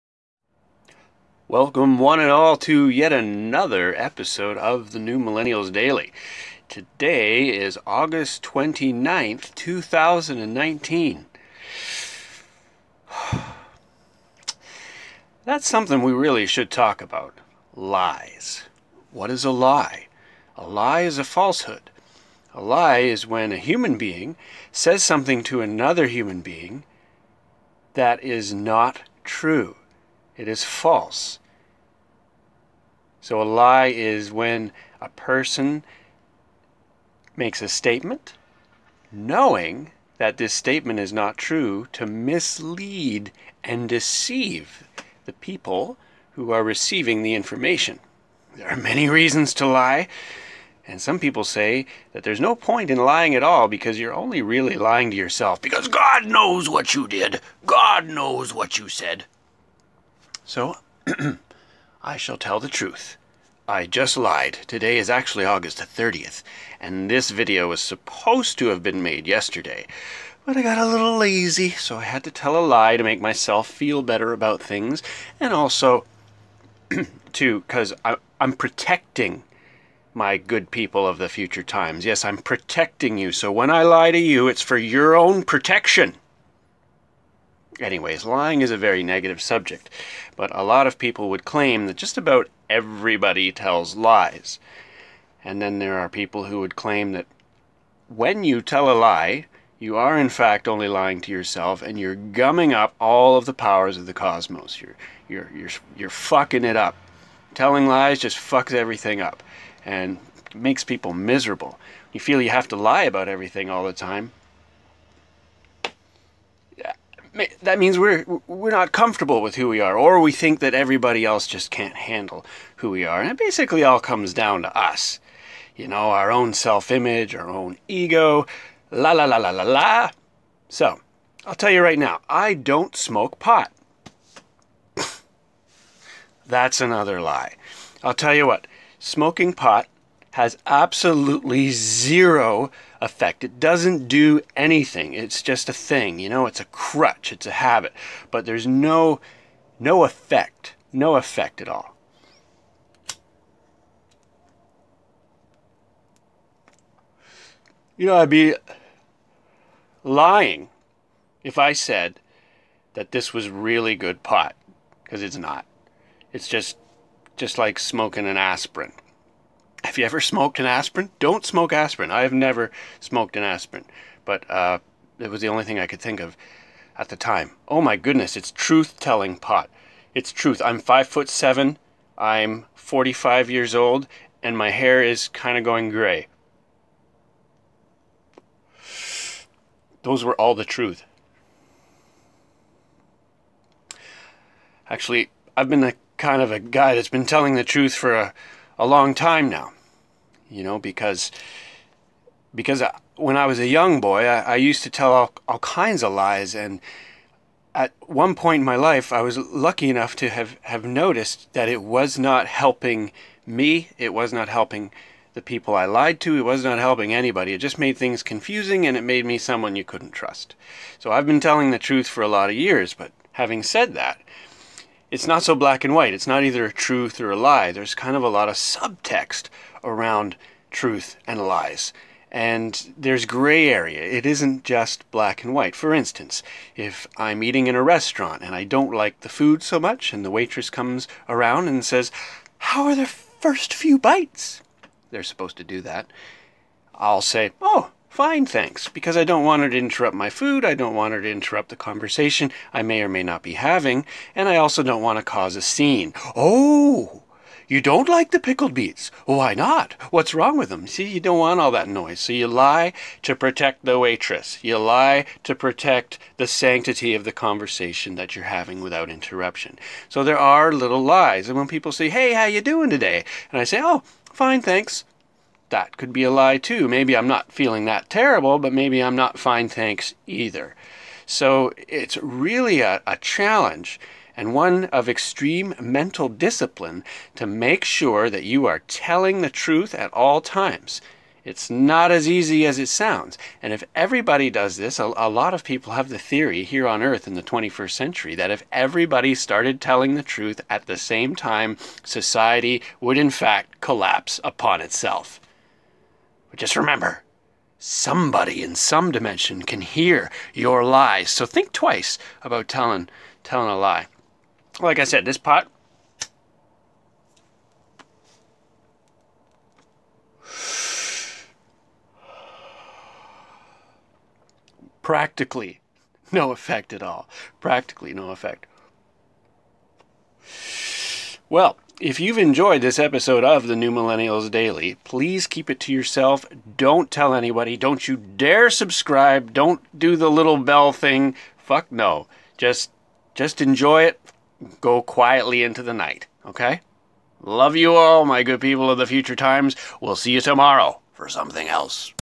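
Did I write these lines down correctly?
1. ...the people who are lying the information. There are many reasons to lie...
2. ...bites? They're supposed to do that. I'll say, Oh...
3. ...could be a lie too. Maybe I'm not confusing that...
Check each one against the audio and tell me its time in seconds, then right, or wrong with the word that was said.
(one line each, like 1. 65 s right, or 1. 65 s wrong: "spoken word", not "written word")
1. 45 s wrong: "receiving", not "lying"
2. 243 s right
3. 275 s wrong: "feeling", not "confusing".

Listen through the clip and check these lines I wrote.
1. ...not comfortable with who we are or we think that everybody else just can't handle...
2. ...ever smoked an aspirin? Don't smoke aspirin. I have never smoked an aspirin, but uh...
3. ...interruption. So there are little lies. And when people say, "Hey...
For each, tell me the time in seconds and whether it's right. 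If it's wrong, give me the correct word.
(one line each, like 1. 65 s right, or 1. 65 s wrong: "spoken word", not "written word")
1. 118 s right
2. 170 s right
3. 269 s right.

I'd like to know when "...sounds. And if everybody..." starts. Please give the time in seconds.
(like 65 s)
292 s.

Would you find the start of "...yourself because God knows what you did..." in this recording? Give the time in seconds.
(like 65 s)
55 s.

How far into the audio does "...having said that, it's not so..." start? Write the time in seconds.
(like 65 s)
223 s.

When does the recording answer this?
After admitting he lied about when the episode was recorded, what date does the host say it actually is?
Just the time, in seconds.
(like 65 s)
65 s.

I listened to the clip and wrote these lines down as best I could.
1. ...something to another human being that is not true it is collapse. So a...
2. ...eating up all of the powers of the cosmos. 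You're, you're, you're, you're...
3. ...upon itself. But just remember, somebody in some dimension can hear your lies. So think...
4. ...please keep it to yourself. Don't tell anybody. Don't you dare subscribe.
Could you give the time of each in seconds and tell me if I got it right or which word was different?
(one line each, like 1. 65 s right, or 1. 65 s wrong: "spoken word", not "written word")
1. 25 s wrong: "false", not "collapse"
2. 102 s wrong: "gumming", not "eating"
3. 304 s right
4. 335 s right.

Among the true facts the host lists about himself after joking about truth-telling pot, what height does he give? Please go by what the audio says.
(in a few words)
5 foot 7.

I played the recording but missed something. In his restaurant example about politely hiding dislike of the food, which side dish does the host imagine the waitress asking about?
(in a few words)
pickled beets.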